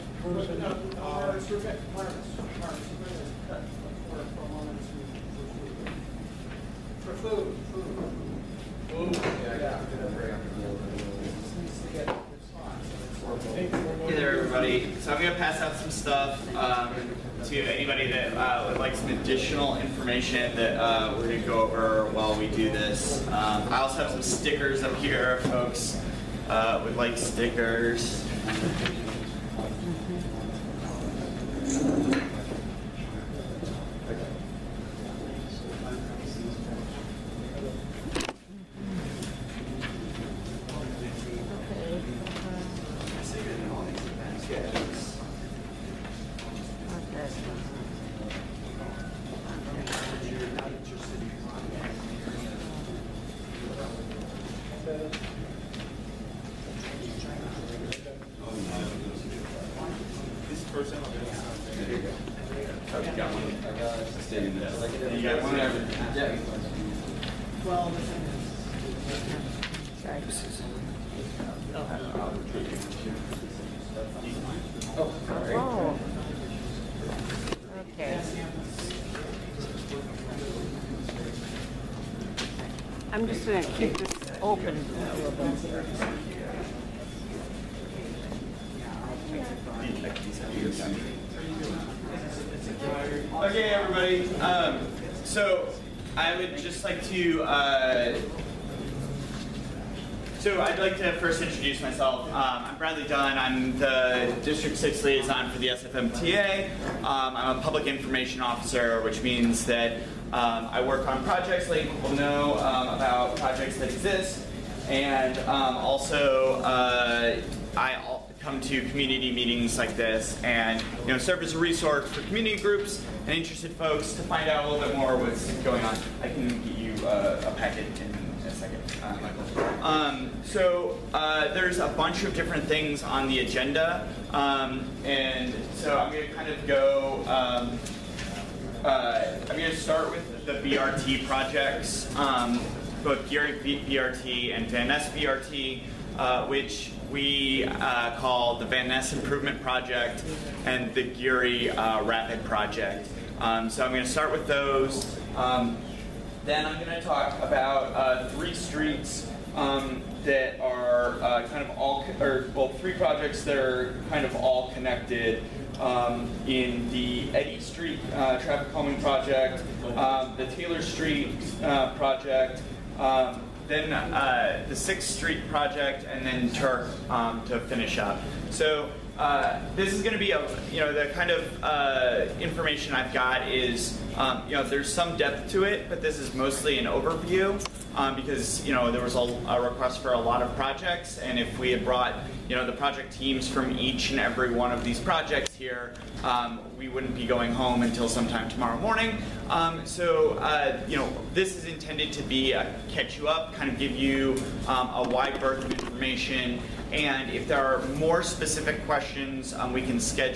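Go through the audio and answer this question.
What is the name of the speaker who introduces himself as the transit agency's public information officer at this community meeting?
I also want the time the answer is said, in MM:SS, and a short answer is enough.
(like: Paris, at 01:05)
Bradley Dunn, at 01:42.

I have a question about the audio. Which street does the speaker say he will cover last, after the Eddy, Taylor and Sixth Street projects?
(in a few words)
Turk.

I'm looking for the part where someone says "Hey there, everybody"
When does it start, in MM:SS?
00:14.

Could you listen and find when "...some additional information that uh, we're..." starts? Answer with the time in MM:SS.
00:18.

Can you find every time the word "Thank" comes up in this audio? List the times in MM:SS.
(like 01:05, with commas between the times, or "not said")
00:31.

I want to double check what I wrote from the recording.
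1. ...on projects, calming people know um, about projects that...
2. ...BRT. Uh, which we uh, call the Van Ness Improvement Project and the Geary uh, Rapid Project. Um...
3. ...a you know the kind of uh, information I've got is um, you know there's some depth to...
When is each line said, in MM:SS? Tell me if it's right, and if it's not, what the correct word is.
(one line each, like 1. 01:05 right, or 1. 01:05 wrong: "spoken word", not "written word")
1. 01:51 wrong: "letting", not "calming"
2. 02:24 right
3. 03:00 right.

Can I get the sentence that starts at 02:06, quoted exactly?
I can get you uh, a packet in a second, uh, Michael.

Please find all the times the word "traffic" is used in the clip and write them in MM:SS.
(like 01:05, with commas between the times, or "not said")
02:48.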